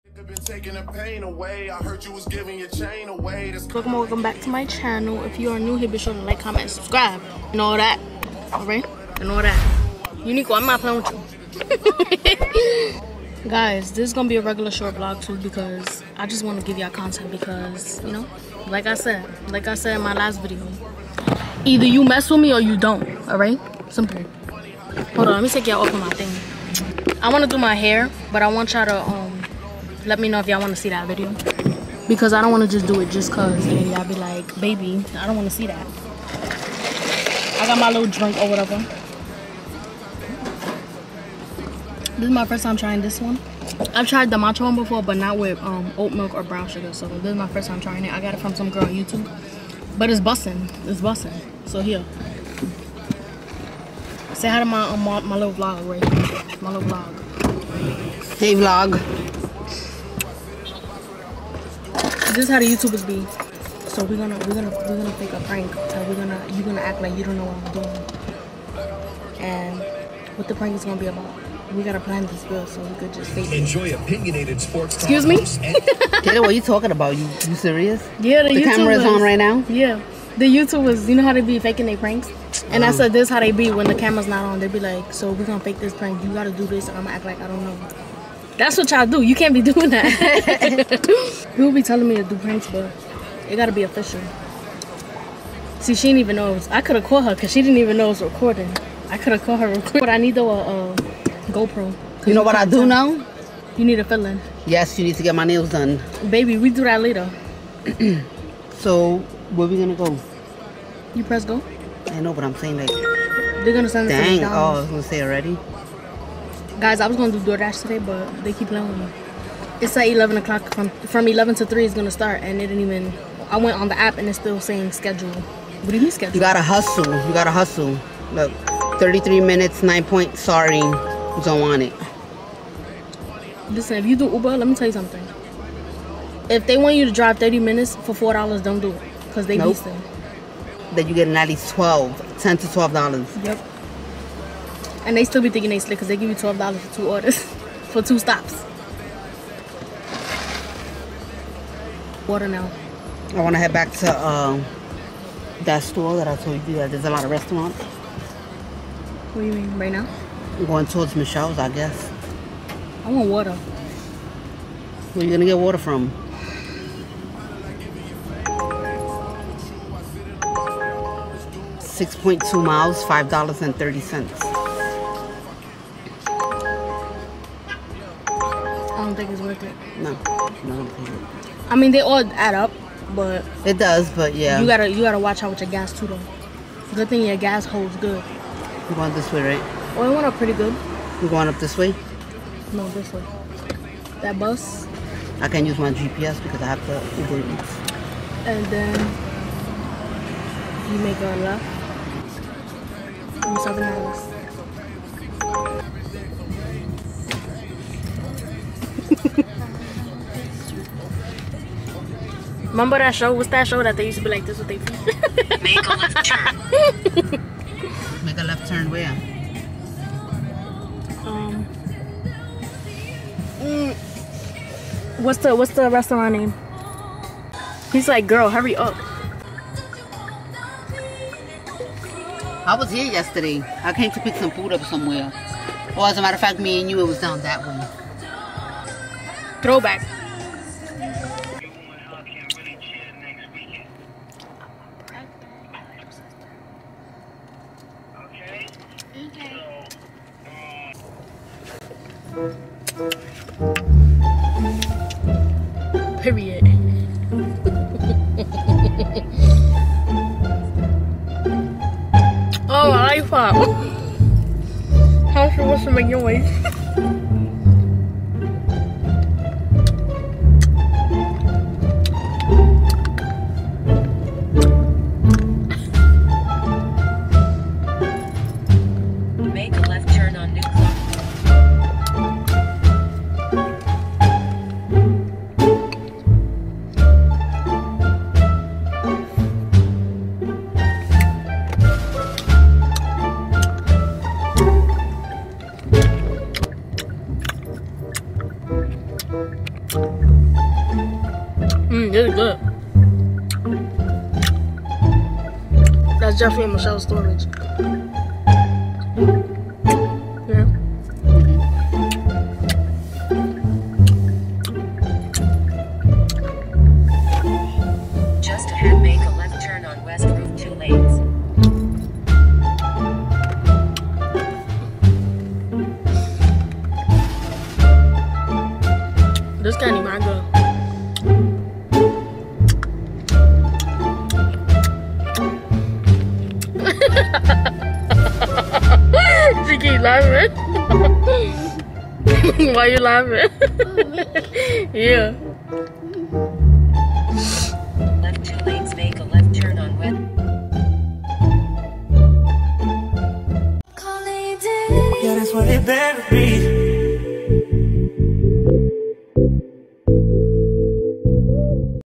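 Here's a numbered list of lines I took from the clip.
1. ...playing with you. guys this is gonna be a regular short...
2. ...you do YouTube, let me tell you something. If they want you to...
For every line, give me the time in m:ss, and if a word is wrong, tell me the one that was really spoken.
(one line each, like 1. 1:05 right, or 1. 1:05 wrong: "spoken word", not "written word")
1. 0:10 right
2. 2:14 wrong: "Uber", not "YouTube".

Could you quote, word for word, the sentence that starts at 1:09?
And what the prank is gonna be about.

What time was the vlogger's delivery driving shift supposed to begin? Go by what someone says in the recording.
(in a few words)
11 o'clock.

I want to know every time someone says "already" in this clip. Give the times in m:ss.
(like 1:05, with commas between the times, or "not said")
1:55.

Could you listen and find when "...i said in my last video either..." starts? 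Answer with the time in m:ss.
0:19.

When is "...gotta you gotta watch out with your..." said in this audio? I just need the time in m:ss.
3:04.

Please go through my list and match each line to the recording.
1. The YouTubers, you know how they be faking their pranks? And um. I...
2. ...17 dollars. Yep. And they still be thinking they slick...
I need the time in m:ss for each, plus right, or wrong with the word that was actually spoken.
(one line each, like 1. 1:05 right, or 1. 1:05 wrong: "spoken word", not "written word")
1. 1:20 right
2. 2:22 wrong: "12", not "17".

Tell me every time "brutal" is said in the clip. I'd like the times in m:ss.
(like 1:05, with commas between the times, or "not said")
not said.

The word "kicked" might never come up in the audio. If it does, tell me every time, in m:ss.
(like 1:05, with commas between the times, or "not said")
not said.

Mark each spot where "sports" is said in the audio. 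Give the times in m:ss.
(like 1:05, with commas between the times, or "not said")
1:14.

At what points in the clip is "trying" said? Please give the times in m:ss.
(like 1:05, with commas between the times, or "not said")
0:42, 0:47.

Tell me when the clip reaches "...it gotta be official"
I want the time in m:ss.
1:33.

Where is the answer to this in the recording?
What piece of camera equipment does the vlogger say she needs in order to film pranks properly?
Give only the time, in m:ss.
1:41.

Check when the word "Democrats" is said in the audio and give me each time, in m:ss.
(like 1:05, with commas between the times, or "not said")
not said.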